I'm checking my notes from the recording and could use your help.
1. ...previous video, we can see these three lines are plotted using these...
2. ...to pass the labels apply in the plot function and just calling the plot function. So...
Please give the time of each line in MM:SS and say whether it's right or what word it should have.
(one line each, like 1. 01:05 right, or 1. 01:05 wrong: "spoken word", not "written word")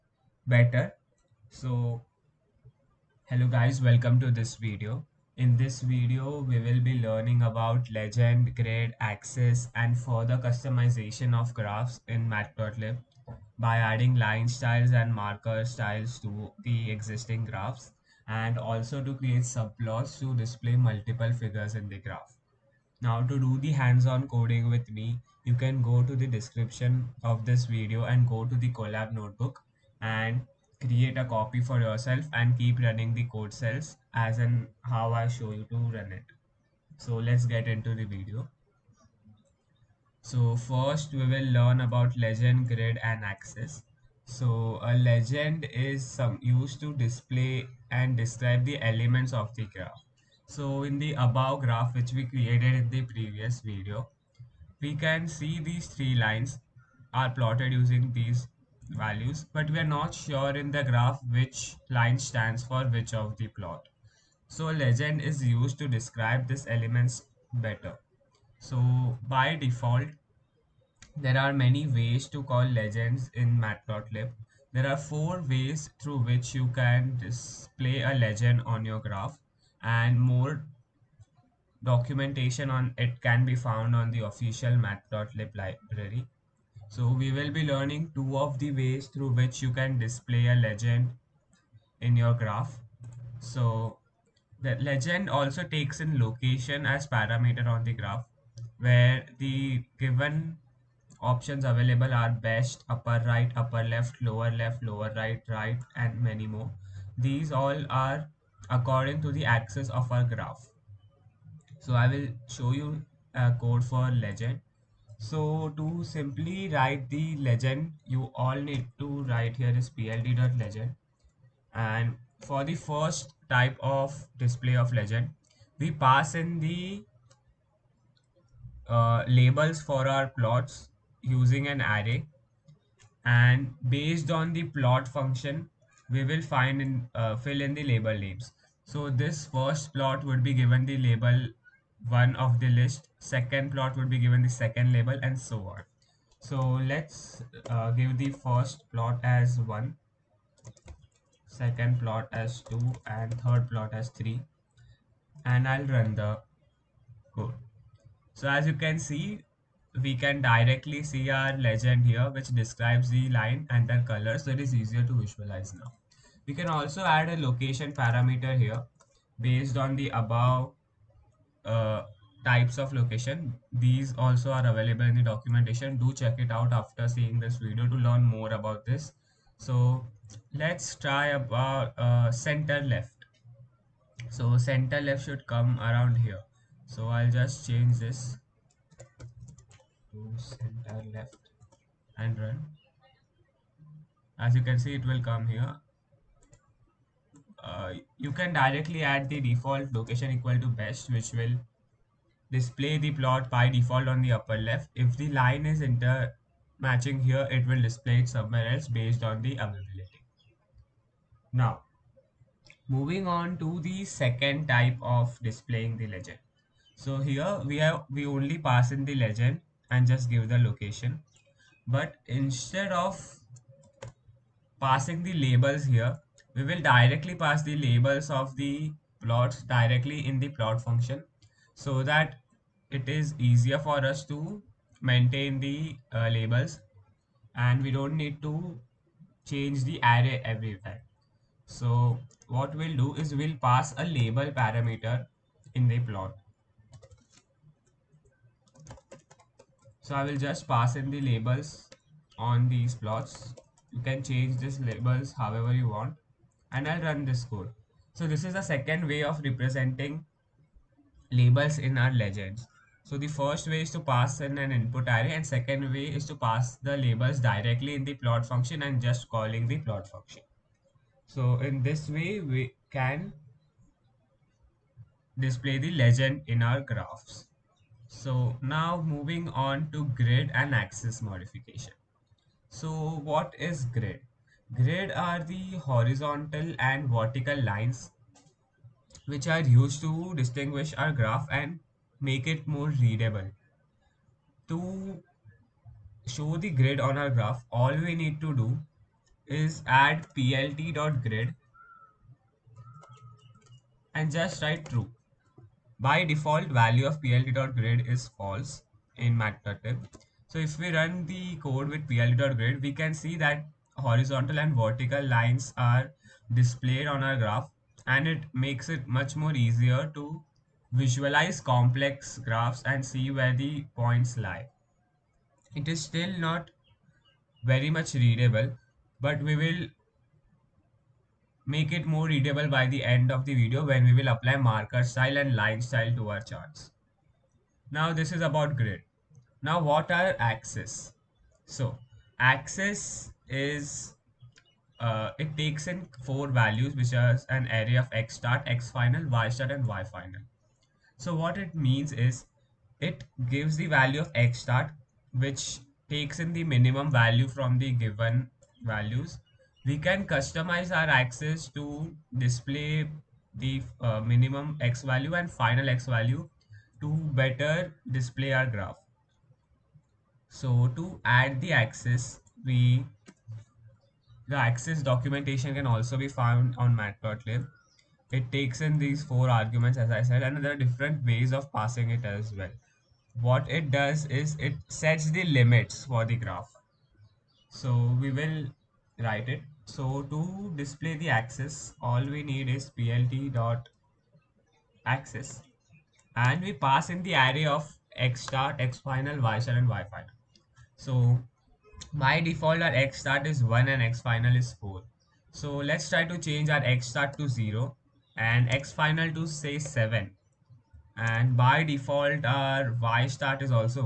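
1. 00:53 right
2. 04:26 wrong: "directly", not "apply".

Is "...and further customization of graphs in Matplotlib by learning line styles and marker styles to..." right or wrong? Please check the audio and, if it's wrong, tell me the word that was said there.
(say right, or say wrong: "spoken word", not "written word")
wrong: "adding", not "learning".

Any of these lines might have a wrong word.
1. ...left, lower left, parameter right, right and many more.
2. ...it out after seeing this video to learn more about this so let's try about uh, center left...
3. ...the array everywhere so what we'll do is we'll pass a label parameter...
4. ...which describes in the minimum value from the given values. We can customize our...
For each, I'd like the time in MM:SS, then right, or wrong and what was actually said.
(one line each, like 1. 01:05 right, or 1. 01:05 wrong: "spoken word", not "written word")
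1. 01:43 wrong: "lower", not "parameter"
2. 02:56 right
3. 03:59 right
4. 05:55 wrong: "takes", not "describes".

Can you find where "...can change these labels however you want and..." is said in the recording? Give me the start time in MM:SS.
04:14.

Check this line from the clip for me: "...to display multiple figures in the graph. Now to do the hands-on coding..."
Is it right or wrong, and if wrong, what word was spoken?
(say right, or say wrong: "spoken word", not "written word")
right.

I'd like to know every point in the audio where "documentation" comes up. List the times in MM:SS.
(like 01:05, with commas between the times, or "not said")
01:21, 02:55, 06:15.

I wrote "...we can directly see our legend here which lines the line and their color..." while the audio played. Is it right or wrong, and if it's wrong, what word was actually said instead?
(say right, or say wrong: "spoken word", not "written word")
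wrong: "describes", not "lines".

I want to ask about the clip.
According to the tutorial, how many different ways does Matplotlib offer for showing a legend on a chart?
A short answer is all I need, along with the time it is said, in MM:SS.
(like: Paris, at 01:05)
4, at 01:14.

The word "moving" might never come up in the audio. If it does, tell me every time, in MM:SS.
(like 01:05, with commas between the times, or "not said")
03:32, 04:39.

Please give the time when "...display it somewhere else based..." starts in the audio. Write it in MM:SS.
03:27.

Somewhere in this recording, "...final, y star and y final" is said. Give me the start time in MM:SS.
06:38.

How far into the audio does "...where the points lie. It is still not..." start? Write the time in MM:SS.
05:23.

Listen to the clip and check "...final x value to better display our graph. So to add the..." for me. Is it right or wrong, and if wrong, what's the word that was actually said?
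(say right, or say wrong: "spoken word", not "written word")
right.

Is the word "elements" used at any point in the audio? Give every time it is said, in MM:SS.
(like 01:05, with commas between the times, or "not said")
00:48, 01:06.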